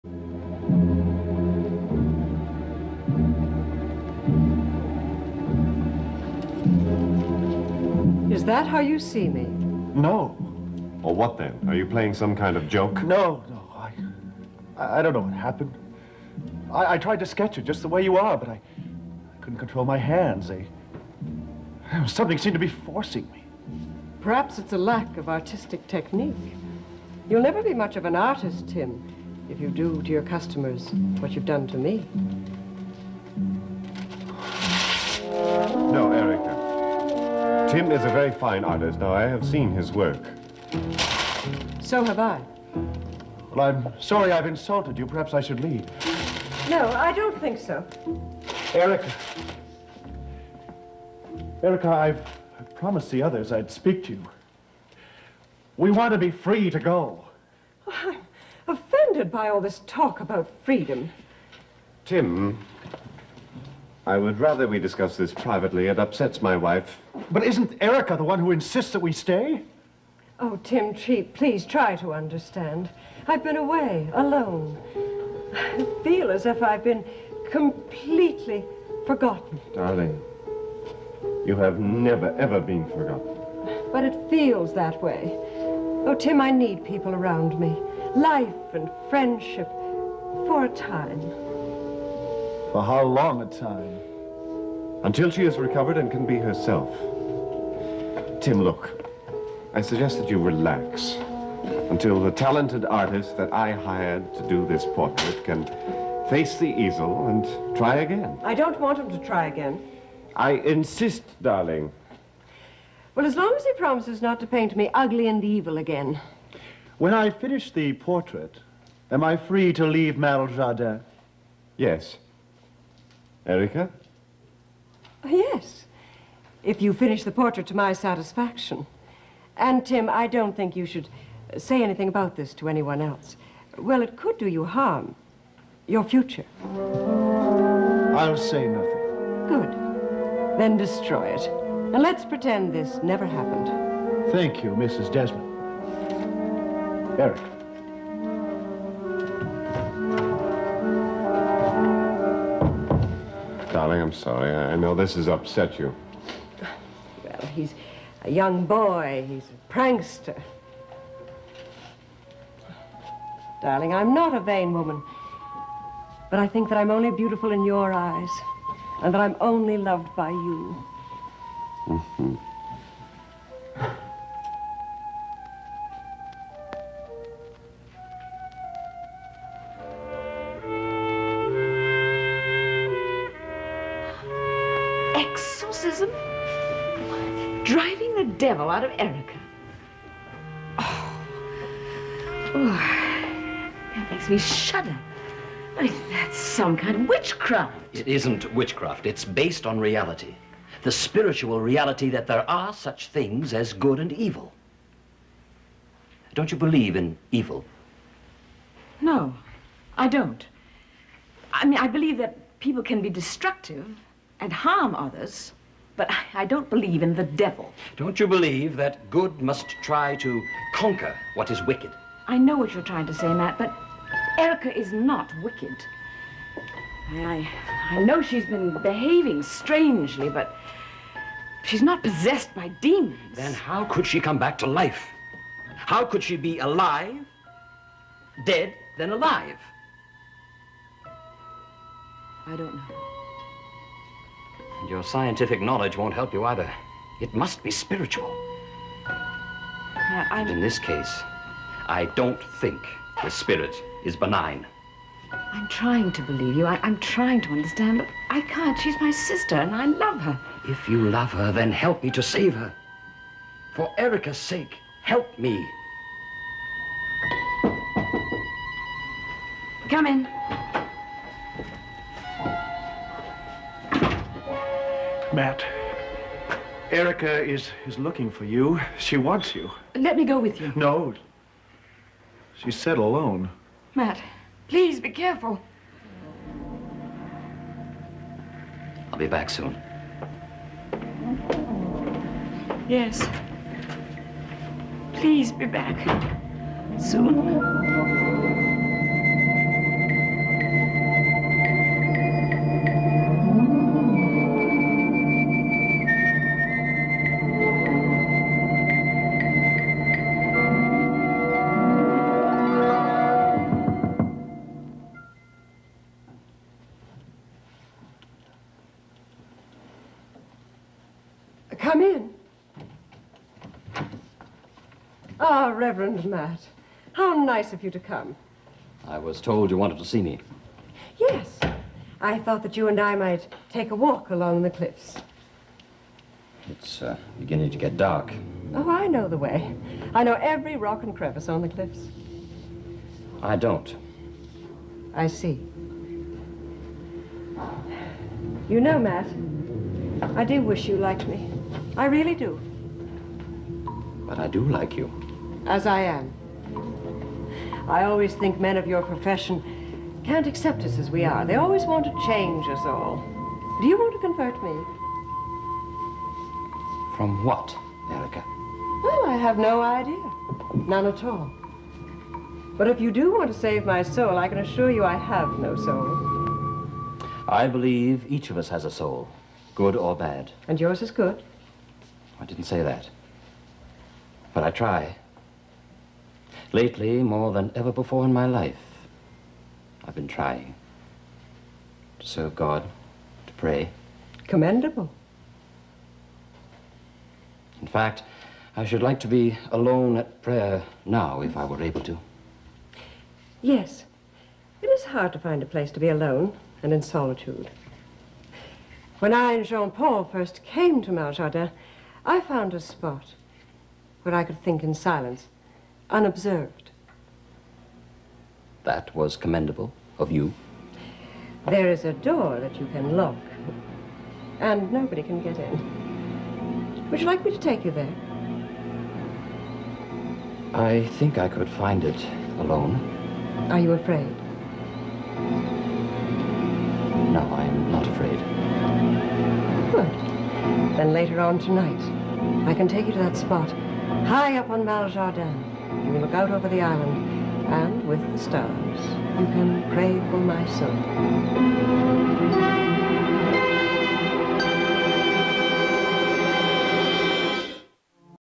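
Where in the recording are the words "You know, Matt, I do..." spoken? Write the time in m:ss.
5:48.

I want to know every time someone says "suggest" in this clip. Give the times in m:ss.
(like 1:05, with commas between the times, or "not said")
1:39.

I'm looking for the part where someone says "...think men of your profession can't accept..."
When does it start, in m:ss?
5:58.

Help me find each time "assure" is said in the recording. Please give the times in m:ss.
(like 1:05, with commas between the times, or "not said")
6:14.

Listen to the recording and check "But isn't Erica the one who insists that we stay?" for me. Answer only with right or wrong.
right.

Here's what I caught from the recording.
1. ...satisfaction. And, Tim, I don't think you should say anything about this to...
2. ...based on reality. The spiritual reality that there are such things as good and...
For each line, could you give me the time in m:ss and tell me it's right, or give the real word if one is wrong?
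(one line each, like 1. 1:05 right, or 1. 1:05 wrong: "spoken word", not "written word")
1. 2:07 right
2. 3:19 right.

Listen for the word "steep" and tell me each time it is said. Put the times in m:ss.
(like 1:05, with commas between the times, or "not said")
not said.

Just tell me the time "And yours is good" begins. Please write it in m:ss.
6:20.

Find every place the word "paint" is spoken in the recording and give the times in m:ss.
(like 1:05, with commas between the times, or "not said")
1:54.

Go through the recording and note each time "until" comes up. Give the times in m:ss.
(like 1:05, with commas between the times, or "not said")
1:35, 1:41.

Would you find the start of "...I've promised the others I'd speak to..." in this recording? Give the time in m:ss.
0:51.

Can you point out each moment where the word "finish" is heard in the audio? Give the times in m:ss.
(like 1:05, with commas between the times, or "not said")
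1:57, 2:06.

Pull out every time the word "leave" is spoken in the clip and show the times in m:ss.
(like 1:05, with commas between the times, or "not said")
0:45, 1:59.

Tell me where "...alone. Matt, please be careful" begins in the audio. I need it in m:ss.
4:42.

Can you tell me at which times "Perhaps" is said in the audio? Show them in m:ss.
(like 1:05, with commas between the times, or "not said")
0:24, 0:45.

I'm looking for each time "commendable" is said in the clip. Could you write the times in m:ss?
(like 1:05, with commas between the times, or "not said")
6:34, 6:59.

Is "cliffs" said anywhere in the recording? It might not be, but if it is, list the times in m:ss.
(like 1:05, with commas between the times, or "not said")
5:34, 5:41.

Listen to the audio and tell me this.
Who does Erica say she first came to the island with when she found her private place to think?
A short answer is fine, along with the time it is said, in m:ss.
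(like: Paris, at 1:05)
Jean-Paul, at 6:49.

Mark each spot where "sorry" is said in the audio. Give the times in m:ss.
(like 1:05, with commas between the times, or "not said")
0:44, 2:34.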